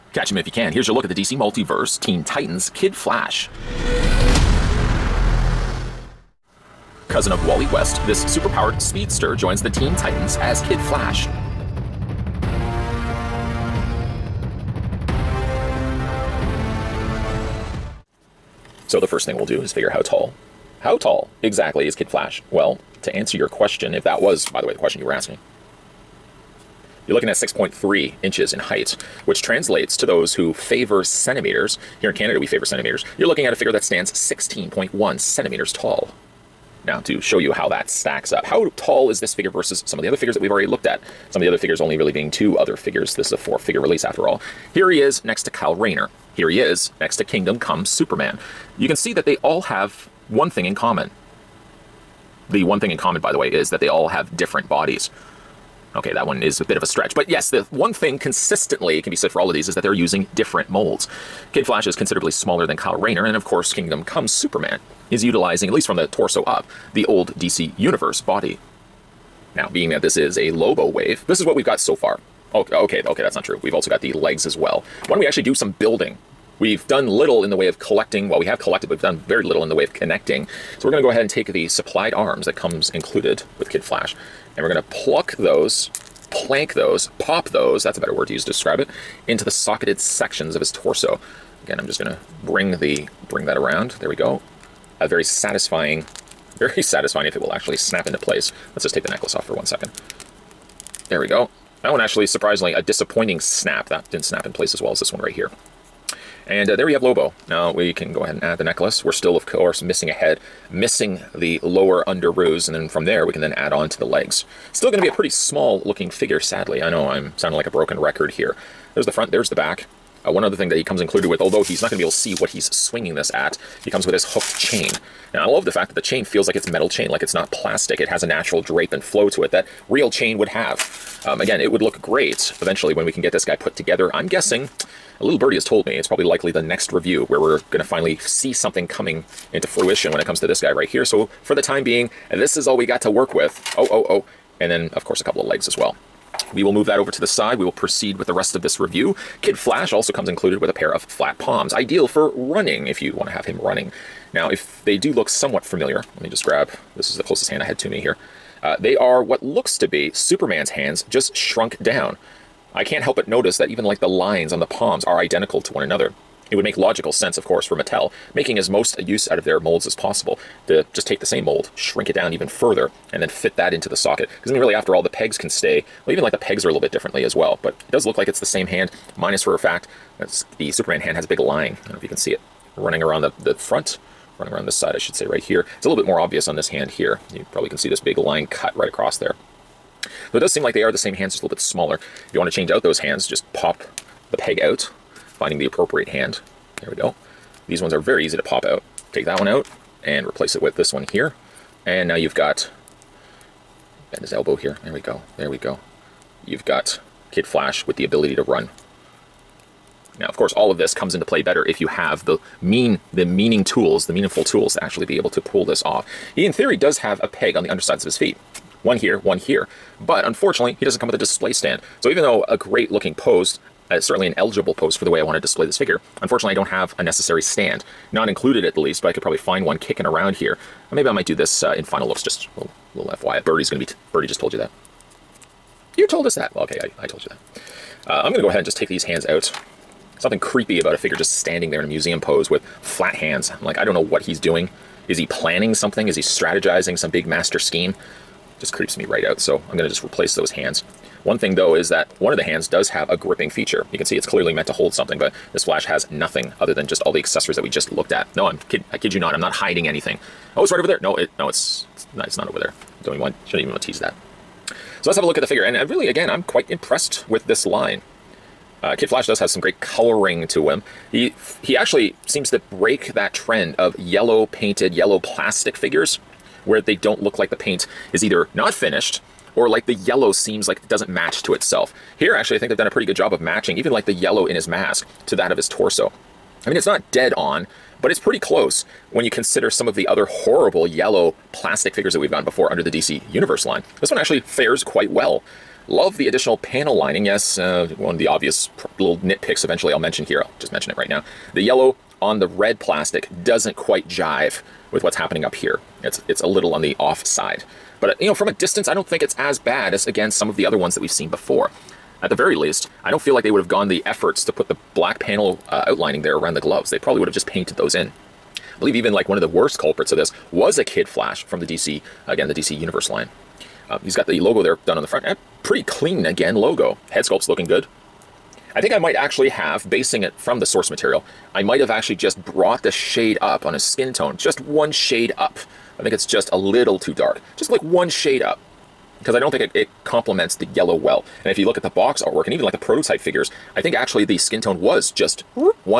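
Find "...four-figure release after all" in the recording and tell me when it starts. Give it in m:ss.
0:43.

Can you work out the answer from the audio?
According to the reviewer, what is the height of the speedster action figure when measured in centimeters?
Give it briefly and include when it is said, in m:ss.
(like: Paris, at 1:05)
16.1 centimeters, at 0:34.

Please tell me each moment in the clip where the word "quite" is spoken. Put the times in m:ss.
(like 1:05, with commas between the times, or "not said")
4:26, 4:54, 5:03.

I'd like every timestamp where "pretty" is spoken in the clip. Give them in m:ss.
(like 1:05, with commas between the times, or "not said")
1:55, 4:42, 4:48, 5:25.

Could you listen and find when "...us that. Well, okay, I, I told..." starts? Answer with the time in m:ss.
3:56.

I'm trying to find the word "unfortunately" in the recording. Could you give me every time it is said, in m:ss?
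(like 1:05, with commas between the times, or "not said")
3:40, 3:46.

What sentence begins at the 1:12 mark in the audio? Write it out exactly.
Okay, okay, okay, that's not true.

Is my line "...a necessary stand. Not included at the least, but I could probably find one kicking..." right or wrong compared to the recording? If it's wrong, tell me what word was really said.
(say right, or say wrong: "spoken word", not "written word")
right.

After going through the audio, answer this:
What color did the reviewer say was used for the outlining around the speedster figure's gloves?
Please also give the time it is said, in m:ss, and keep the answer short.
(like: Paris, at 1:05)
black, at 5:14.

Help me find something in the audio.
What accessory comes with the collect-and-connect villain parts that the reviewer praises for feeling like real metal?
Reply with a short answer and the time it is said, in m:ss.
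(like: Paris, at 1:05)
hooked chain, at 2:04.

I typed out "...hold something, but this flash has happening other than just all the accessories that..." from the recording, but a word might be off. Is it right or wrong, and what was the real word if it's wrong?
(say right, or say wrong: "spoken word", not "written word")
wrong: "nothing", not "happening".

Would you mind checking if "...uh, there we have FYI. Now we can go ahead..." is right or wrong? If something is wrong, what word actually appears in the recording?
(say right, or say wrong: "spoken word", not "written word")
wrong: "Lobo", not "FYI".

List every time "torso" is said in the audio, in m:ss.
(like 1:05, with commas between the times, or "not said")
1:06, 1:30, 4:45.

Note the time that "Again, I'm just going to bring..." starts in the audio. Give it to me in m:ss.
1:31.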